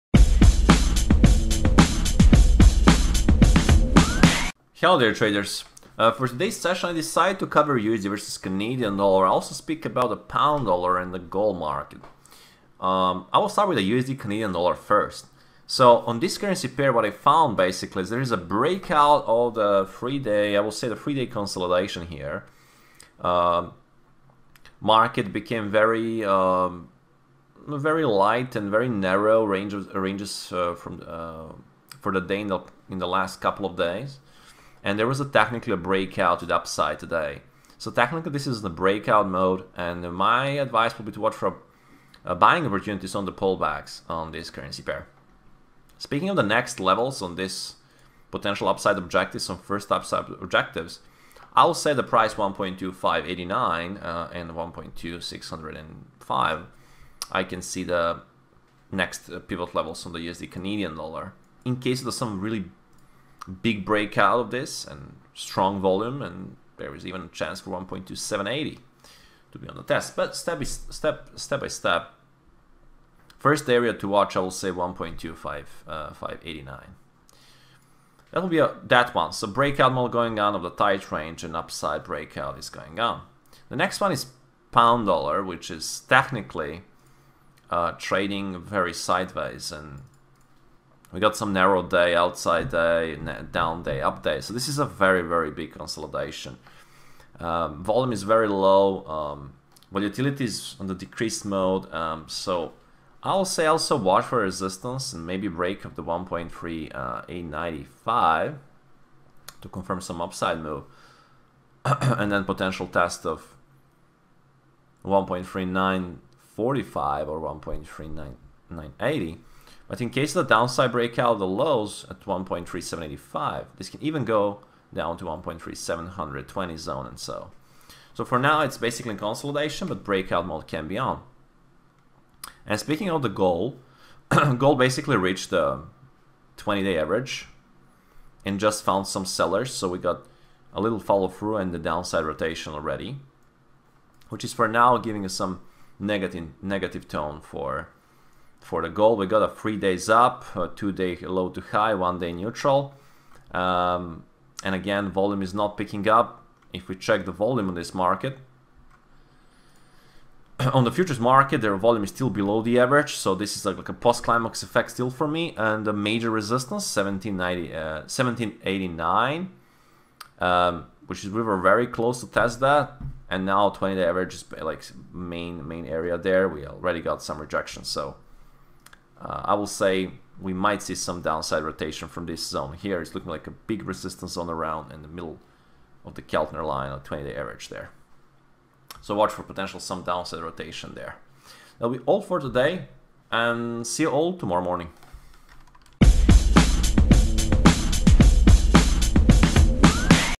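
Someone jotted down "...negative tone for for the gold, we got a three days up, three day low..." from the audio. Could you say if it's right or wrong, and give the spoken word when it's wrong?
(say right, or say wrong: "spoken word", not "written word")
wrong: "two", not "three".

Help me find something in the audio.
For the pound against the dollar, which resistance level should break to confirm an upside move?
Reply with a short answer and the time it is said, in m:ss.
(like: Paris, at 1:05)
1.3895, at 1:46.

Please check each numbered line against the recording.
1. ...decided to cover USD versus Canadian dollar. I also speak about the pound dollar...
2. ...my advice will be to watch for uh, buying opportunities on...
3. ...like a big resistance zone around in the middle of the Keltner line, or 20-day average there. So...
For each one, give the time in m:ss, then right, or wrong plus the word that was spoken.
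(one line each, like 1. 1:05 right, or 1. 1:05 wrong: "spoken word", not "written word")
1. 0:06 right
2. 0:40 right
3. 3:03 right.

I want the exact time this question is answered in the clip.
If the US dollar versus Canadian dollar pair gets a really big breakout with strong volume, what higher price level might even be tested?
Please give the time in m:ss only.
1:07.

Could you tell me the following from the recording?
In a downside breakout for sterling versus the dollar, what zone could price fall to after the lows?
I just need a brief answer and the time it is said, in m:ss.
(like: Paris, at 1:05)
1.3720, at 2:05.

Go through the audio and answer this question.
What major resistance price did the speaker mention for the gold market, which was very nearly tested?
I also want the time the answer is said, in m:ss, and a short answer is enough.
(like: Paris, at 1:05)
1789, at 2:48.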